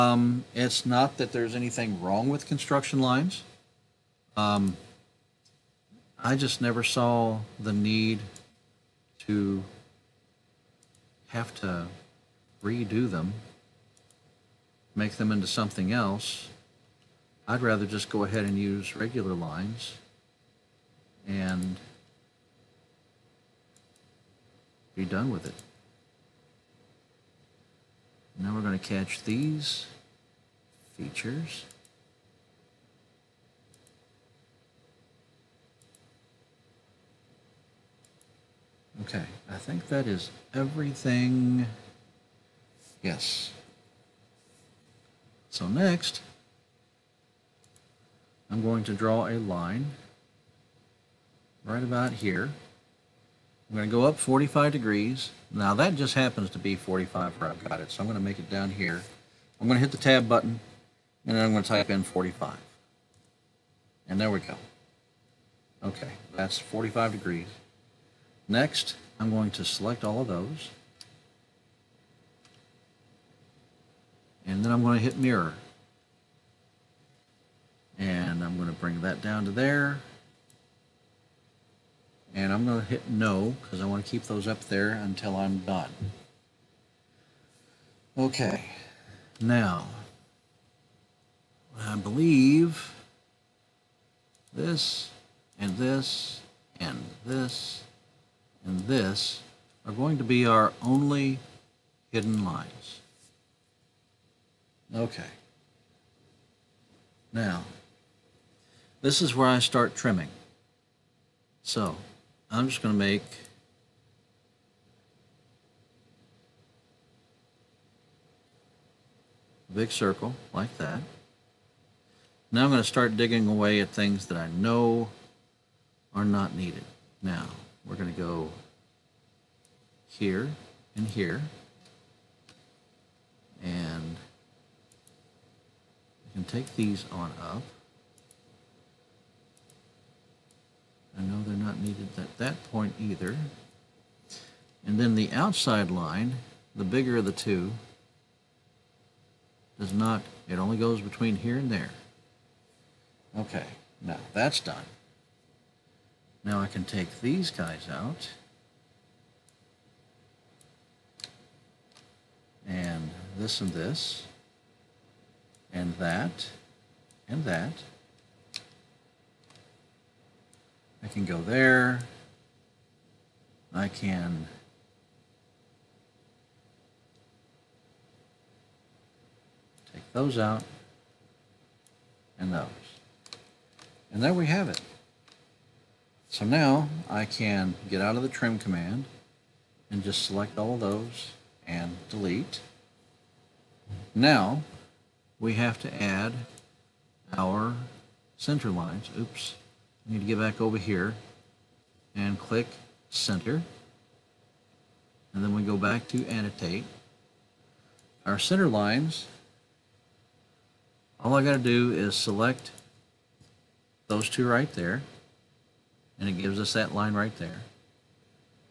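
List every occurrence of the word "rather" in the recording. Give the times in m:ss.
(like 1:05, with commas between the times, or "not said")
0:17.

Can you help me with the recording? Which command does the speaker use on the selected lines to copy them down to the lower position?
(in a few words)
mirror.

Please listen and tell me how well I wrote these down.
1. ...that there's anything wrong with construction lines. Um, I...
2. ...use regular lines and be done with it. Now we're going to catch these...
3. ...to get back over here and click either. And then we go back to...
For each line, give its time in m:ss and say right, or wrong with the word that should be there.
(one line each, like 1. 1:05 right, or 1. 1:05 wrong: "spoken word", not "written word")
1. 0:01 right
2. 0:18 right
3. 3:20 wrong: "center", not "either".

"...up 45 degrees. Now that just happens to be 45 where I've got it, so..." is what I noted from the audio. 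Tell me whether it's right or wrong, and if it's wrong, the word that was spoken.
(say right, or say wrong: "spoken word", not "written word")
right.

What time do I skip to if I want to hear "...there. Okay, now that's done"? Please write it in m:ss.
2:31.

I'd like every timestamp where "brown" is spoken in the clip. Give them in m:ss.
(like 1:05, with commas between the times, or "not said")
not said.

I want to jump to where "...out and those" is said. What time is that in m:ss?
3:00.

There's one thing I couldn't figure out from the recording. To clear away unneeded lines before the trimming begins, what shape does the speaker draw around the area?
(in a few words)
big circle.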